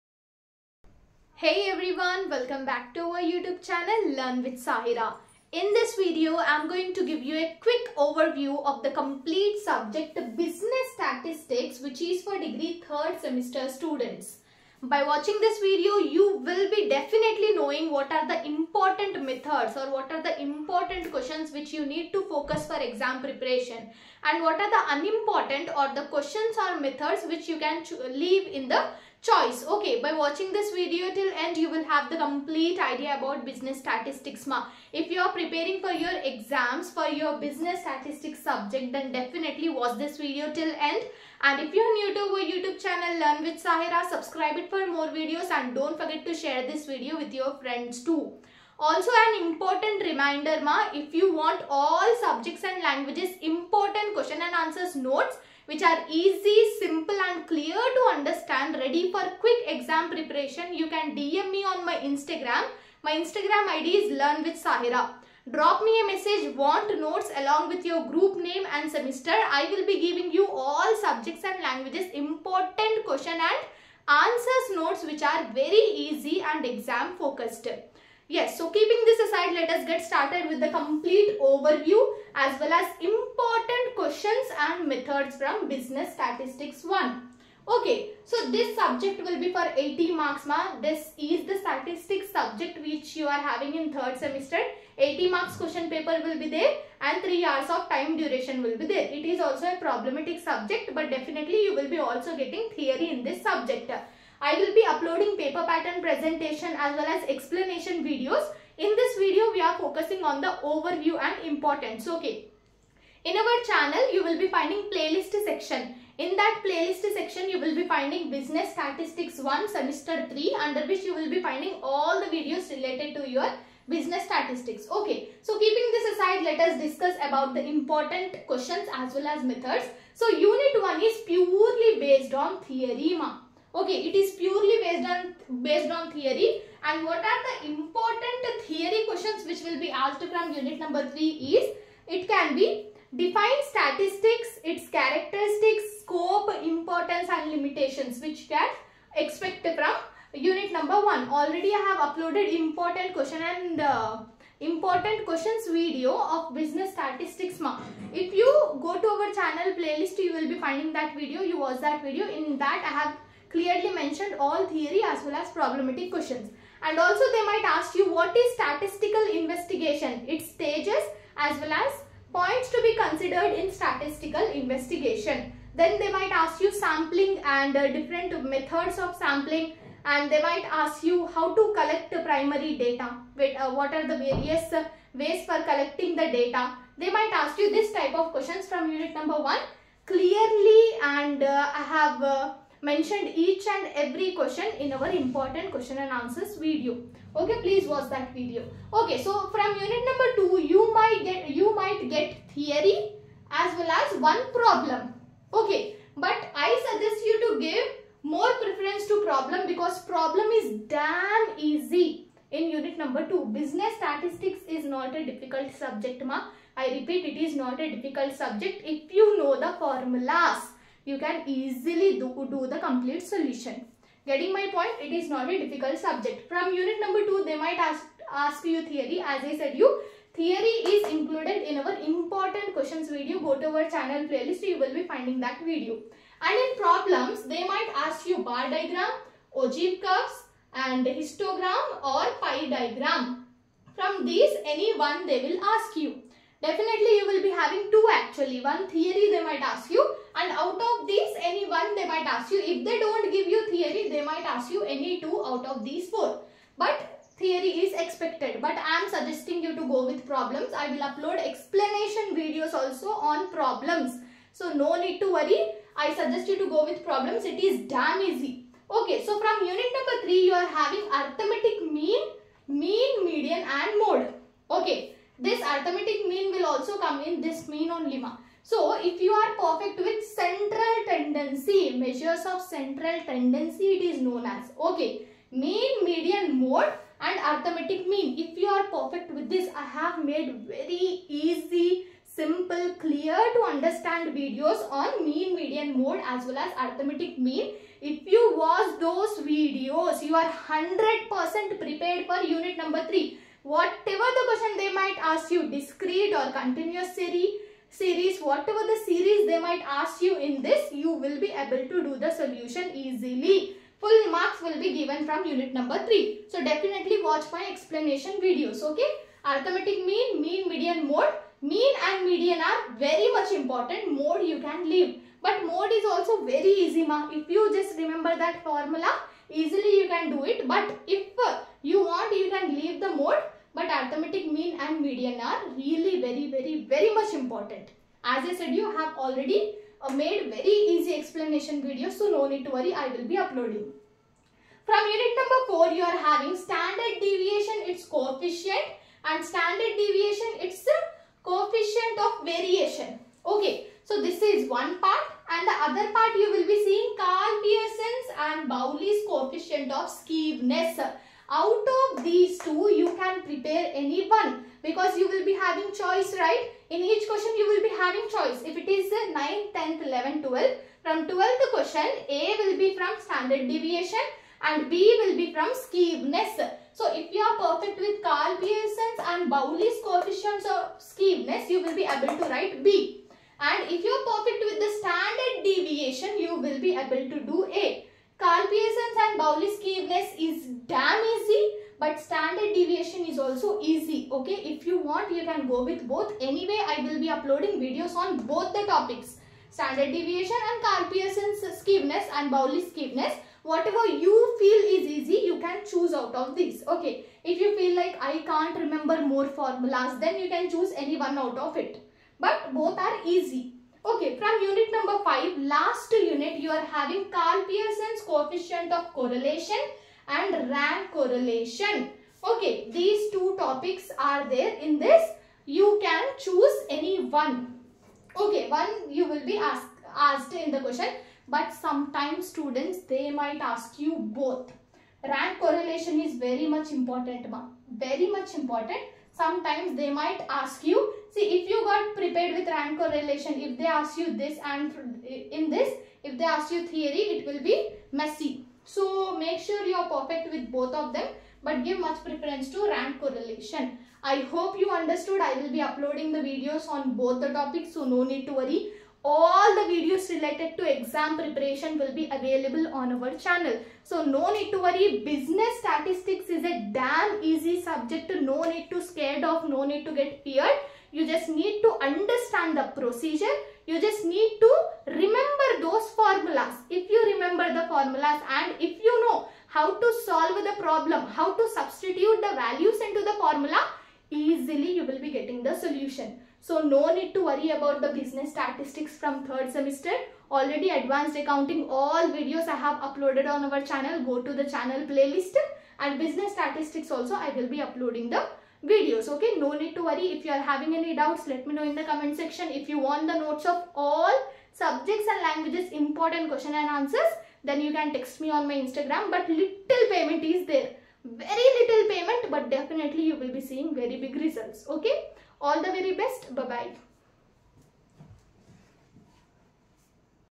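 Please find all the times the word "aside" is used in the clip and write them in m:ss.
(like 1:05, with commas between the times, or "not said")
1:19, 2:06.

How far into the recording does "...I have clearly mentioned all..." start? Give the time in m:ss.
2:42.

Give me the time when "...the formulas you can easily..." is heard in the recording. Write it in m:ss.
3:39.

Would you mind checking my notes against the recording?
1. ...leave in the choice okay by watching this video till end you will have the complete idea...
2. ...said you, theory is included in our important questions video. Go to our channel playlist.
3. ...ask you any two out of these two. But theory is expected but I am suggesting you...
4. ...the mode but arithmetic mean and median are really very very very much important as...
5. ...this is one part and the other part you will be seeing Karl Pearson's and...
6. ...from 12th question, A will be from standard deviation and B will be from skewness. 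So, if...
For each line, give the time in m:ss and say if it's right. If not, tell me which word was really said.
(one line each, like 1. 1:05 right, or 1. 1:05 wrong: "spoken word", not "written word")
1. 0:28 right
2. 3:49 right
3. 4:14 wrong: "four", not "two"
4. 5:32 right
5. 5:54 right
6. 6:11 right.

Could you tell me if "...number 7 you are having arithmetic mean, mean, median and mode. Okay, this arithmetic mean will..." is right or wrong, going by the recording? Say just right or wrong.
wrong.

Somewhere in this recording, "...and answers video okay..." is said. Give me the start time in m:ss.
3:16.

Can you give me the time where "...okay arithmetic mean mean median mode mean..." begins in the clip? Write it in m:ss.
5:18.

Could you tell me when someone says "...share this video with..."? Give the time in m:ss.
0:46.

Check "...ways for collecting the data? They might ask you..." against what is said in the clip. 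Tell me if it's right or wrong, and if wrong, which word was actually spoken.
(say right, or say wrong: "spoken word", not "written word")
right.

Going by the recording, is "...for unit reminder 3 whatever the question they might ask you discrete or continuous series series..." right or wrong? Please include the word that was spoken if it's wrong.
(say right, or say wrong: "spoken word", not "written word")
wrong: "number", not "reminder".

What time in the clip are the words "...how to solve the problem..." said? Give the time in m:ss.
7:59.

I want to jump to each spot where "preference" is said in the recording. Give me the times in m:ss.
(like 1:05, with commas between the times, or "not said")
3:28, 7:32.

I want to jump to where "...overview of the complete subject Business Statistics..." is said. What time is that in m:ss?
0:07.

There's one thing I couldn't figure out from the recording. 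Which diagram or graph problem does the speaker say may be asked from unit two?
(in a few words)
Ogive curves.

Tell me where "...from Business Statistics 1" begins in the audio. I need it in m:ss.
1:25.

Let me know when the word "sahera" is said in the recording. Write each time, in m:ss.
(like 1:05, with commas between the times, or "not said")
0:04, 0:43, 1:04.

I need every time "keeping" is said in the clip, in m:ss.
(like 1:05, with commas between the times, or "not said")
1:18, 2:05.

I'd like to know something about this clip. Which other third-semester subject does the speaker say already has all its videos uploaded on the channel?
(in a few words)
Advanced Accounting.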